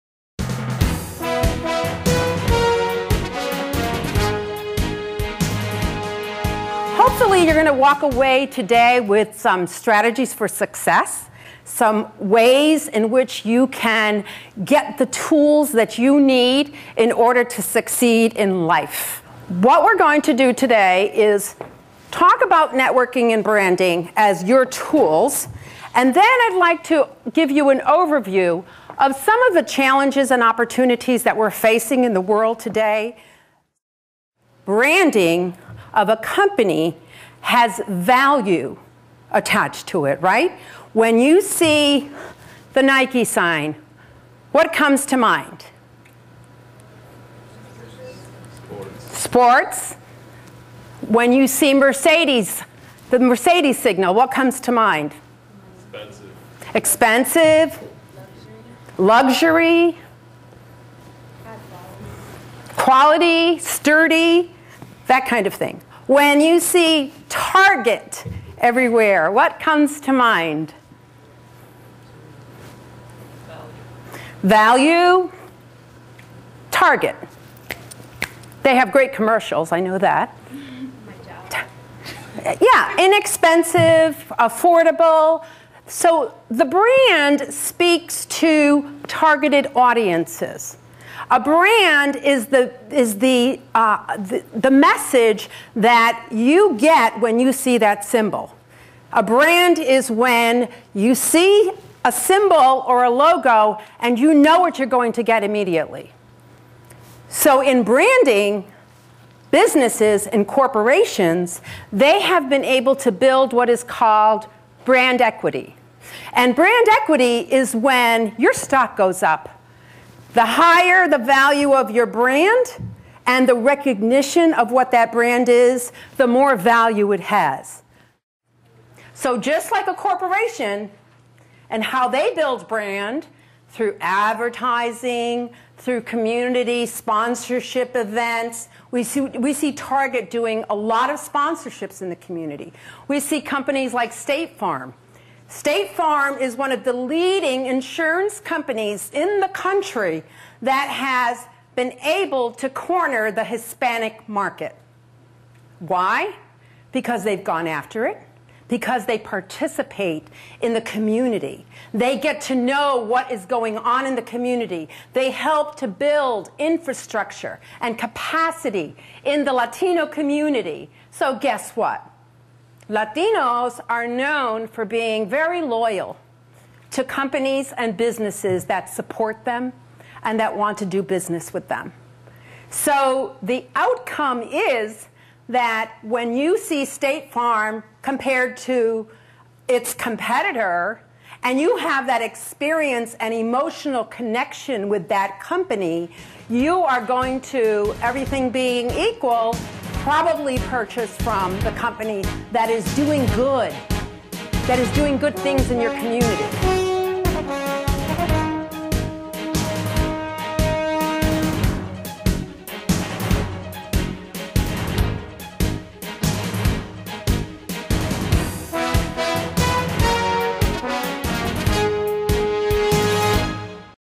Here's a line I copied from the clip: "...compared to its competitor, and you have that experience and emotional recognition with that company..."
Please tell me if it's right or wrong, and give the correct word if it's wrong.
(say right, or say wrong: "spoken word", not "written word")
wrong: "connection", not "recognition".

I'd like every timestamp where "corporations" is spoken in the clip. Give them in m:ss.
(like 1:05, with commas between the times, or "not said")
1:50, 2:09.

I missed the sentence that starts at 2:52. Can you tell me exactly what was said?
Latinos are known for being very loyal to companies and businesses that support them and that want to do business with them.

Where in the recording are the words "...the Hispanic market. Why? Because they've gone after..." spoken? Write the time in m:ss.
2:33.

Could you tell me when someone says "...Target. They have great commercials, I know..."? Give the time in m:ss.
1:16.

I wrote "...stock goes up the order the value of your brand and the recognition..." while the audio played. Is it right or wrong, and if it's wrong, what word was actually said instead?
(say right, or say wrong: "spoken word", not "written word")
wrong: "higher", not "order".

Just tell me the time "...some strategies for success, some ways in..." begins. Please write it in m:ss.
0:09.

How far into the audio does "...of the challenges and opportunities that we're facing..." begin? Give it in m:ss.
0:29.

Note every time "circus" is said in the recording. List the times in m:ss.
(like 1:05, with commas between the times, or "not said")
not said.